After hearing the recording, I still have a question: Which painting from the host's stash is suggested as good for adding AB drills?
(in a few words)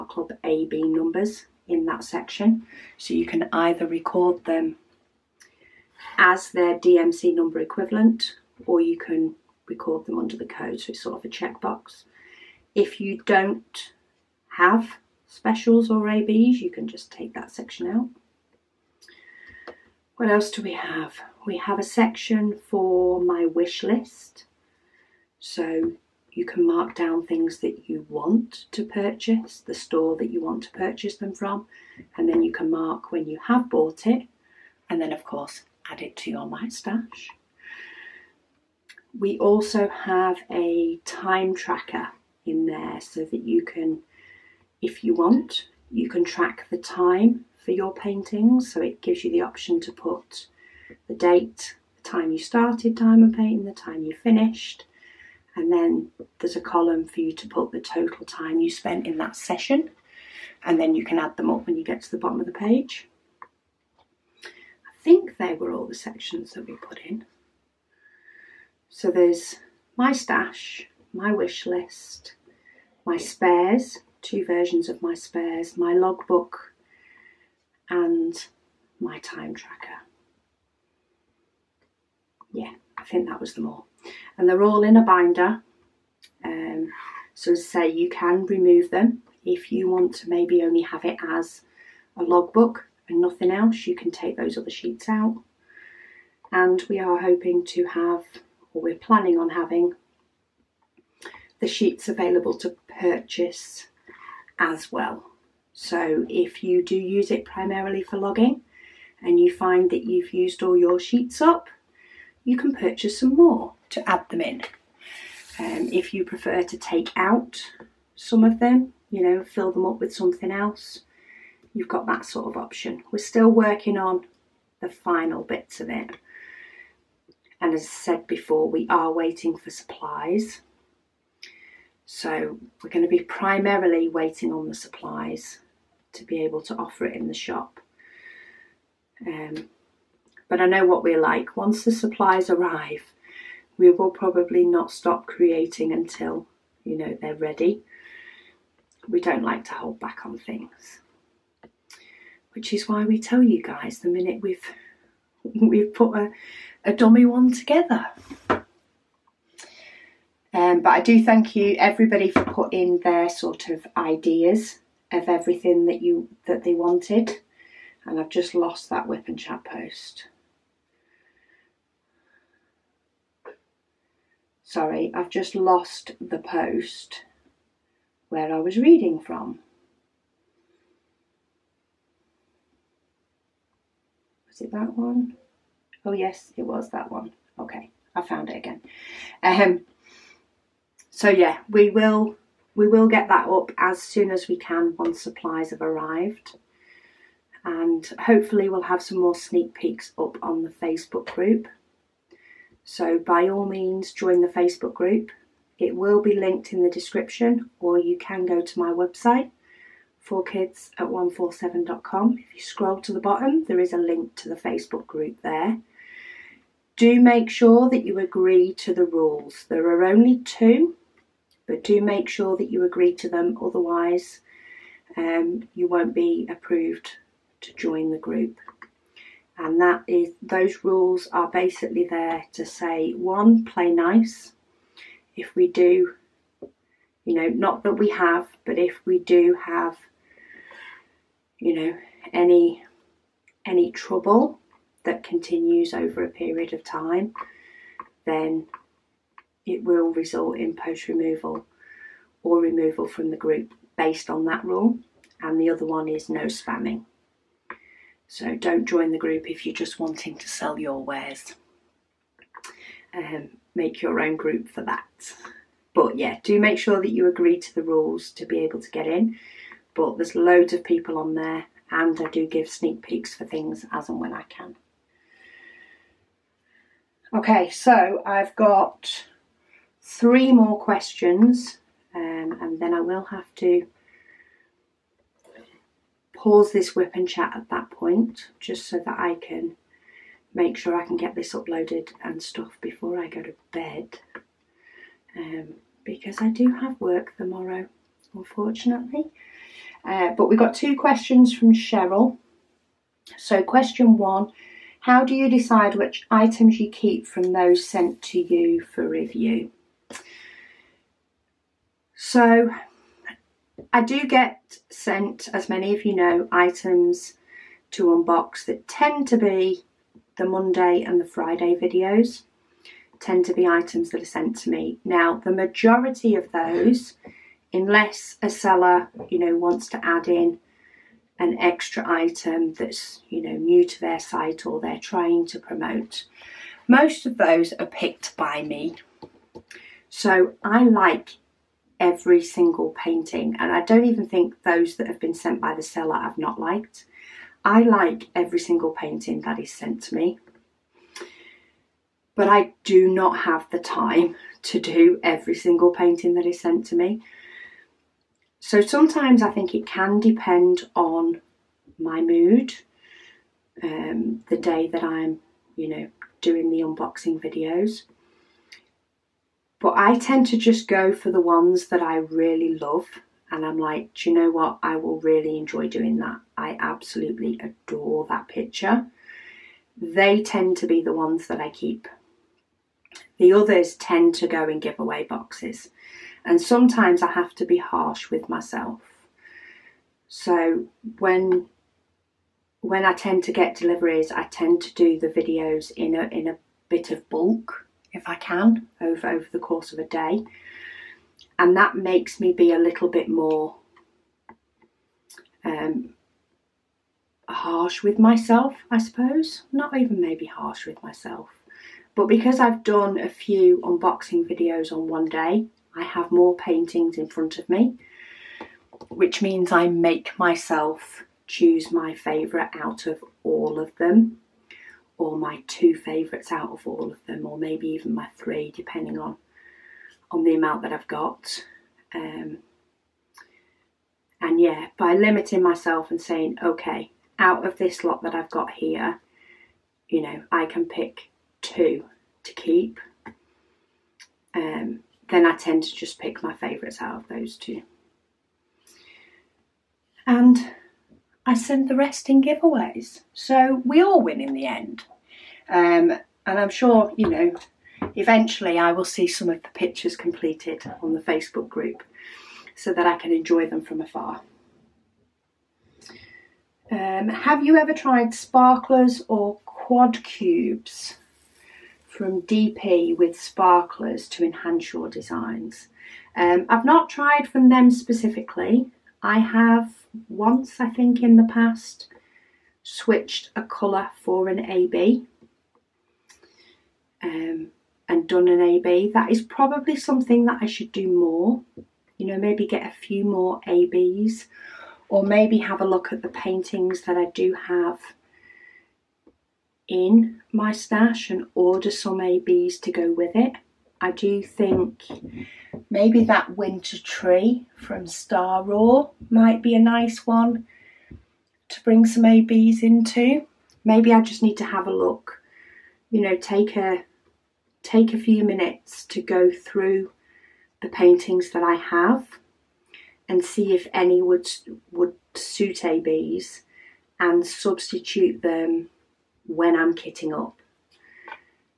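winter tree.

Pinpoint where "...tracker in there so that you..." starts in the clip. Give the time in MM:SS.
00:41.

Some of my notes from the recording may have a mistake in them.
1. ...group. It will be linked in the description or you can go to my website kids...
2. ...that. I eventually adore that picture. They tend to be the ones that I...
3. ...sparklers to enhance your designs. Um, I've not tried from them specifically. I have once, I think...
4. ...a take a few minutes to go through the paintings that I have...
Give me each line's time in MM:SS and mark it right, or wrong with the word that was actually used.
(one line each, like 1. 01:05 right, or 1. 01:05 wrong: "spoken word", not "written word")
1. 03:24 right
2. 06:16 wrong: "absolutely", not "eventually"
3. 07:53 right
4. 08:36 right.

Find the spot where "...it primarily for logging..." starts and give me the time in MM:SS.
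01:47.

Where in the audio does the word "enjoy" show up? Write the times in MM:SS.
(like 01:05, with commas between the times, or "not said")
06:15, 07:43.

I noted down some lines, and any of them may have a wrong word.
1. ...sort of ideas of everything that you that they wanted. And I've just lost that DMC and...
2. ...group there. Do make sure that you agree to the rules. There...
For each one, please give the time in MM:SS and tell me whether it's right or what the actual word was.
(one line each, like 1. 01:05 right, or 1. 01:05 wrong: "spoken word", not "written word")
1. 02:43 wrong: "WIP", not "DMC"
2. 03:35 right.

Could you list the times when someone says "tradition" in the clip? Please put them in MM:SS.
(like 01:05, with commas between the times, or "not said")
not said.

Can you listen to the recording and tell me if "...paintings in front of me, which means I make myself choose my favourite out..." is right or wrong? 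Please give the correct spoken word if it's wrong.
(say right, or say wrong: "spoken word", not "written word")
right.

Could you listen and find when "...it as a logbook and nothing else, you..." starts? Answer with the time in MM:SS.
01:31.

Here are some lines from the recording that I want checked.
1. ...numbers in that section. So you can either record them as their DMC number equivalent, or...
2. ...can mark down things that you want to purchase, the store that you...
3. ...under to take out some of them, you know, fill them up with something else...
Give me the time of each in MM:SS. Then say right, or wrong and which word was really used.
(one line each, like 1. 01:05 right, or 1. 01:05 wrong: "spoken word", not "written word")
1. 00:00 right
2. 00:26 right
3. 01:56 wrong: "prefer", not "under".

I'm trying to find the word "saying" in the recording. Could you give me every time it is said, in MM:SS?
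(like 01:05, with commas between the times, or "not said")
07:16.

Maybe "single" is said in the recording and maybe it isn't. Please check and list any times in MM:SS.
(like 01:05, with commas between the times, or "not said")
05:42, 05:48, 05:55.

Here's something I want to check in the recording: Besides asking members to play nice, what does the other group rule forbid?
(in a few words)
spamming.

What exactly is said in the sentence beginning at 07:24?
Um, then I tend to just pick my favourites out of those two.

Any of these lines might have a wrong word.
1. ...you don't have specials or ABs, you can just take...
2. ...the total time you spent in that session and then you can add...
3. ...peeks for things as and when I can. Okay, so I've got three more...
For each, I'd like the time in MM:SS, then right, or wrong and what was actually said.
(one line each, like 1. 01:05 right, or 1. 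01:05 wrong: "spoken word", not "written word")
1. 00:13 right
2. 00:57 right
3. 04:33 right.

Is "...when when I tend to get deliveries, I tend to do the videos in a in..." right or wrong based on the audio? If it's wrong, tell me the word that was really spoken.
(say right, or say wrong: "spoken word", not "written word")
right.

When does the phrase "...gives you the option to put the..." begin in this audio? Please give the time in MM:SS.
00:49.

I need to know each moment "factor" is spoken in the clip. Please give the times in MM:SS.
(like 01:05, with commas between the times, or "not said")
not said.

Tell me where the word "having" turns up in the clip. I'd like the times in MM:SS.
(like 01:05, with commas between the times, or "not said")
01:39.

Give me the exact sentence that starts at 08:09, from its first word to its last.
That is probably something that I should do more.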